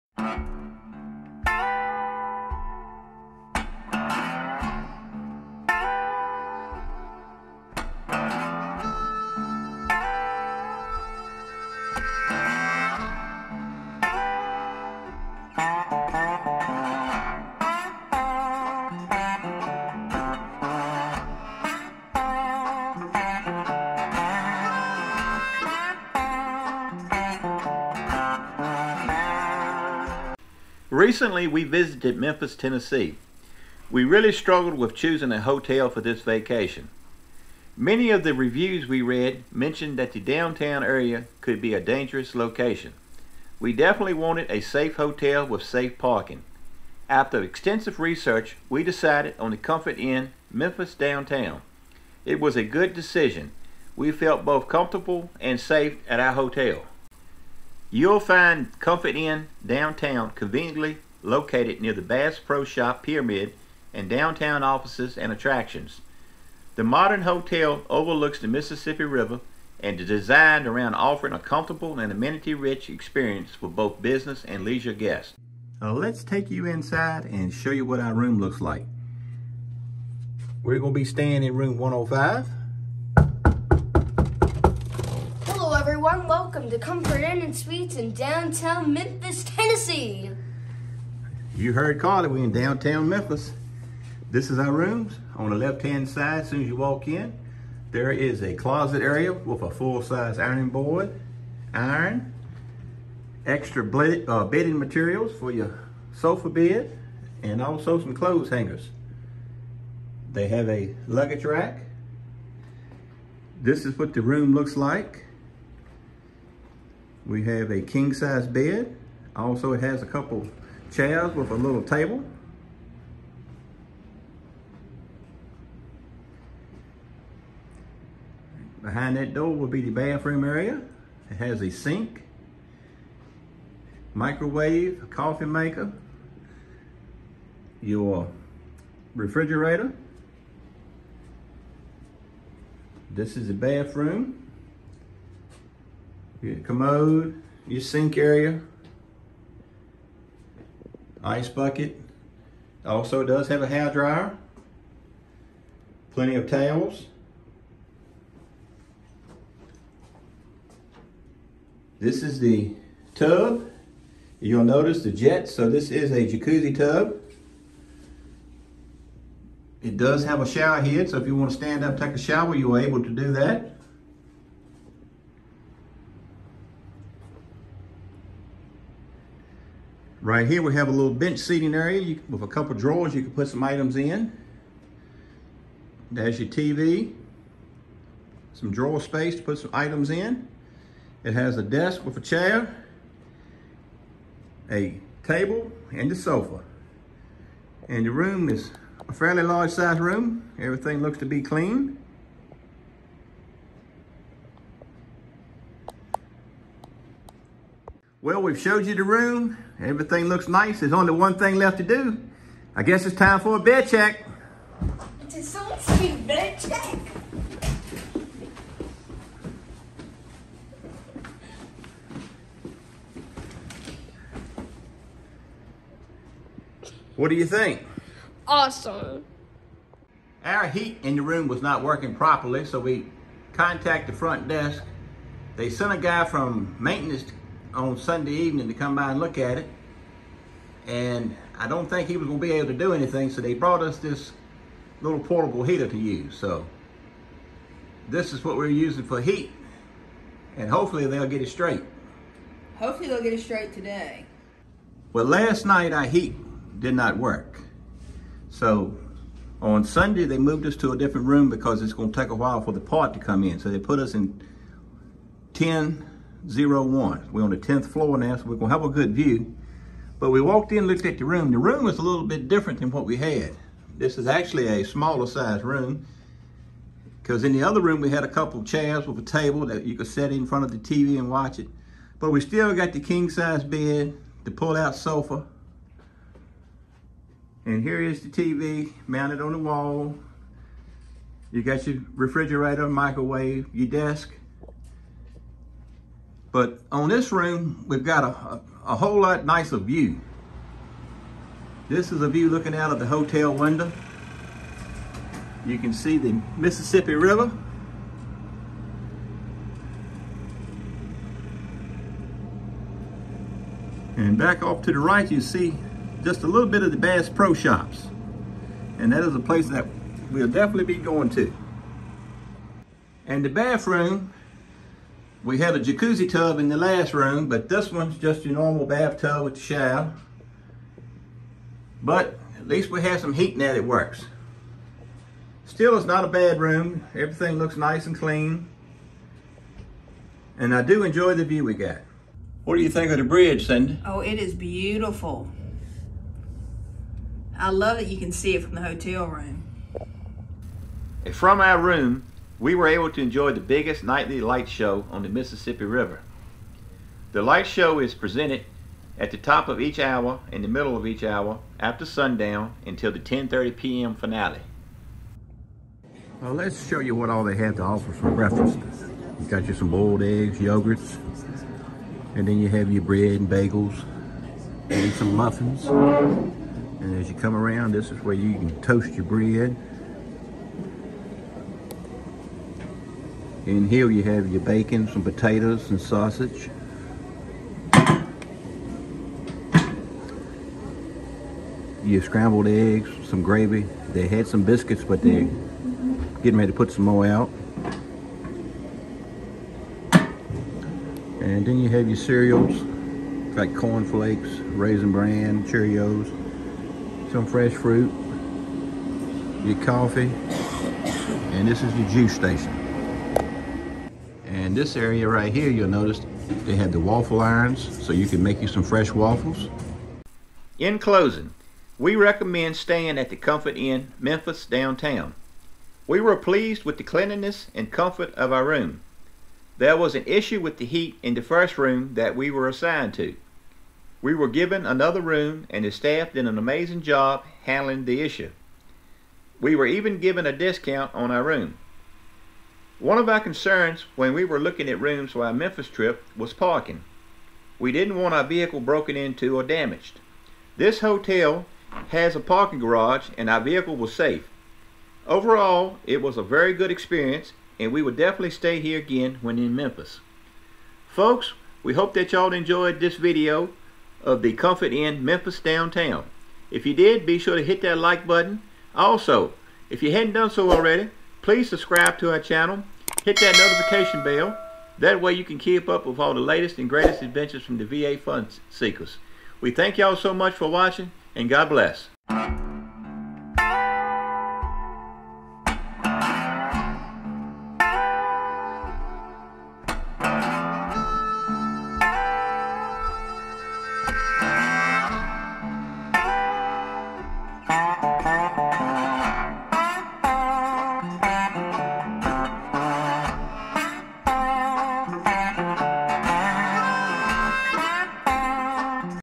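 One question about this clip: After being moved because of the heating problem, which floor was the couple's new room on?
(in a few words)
10th floor.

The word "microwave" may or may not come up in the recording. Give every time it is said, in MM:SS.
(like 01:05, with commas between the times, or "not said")
02:14, 04:52.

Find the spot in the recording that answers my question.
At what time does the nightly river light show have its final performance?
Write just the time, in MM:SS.
06:03.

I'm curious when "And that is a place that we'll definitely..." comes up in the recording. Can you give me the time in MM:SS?
05:18.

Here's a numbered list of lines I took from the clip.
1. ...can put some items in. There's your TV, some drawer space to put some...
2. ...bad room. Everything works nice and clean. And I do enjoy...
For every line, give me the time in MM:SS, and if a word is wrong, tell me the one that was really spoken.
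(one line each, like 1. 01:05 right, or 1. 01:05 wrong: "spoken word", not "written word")
1. 03:03 right
2. 05:36 wrong: "looks", not "works".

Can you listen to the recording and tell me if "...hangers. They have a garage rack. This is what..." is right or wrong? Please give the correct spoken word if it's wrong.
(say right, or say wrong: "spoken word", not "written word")
wrong: "luggage", not "garage".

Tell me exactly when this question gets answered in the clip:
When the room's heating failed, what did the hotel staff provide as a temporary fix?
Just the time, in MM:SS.
04:05.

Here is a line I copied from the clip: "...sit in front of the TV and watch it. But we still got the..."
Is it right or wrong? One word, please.
right.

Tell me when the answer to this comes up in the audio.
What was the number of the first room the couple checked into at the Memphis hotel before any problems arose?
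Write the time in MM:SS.
01:21.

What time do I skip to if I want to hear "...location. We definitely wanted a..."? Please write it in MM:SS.
00:42.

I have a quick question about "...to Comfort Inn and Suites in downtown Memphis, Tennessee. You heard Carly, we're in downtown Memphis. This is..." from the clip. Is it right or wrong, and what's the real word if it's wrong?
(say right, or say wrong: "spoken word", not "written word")
right.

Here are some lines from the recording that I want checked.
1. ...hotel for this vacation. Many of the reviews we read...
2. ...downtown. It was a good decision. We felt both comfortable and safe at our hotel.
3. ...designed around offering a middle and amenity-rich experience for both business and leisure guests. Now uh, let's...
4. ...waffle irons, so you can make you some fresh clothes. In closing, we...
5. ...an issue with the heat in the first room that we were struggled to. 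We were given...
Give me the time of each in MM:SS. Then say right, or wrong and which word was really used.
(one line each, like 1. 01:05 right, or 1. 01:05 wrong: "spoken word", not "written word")
1. 00:35 right
2. 00:50 right
3. 01:10 wrong: "comfortable", not "middle"
4. 06:57 wrong: "waffles", not "clothes"
5. 07:10 wrong: "assigned", not "struggled".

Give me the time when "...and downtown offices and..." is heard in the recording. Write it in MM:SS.
01:03.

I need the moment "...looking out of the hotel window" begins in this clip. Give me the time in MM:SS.
05:02.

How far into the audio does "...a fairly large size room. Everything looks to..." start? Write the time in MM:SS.
03:19.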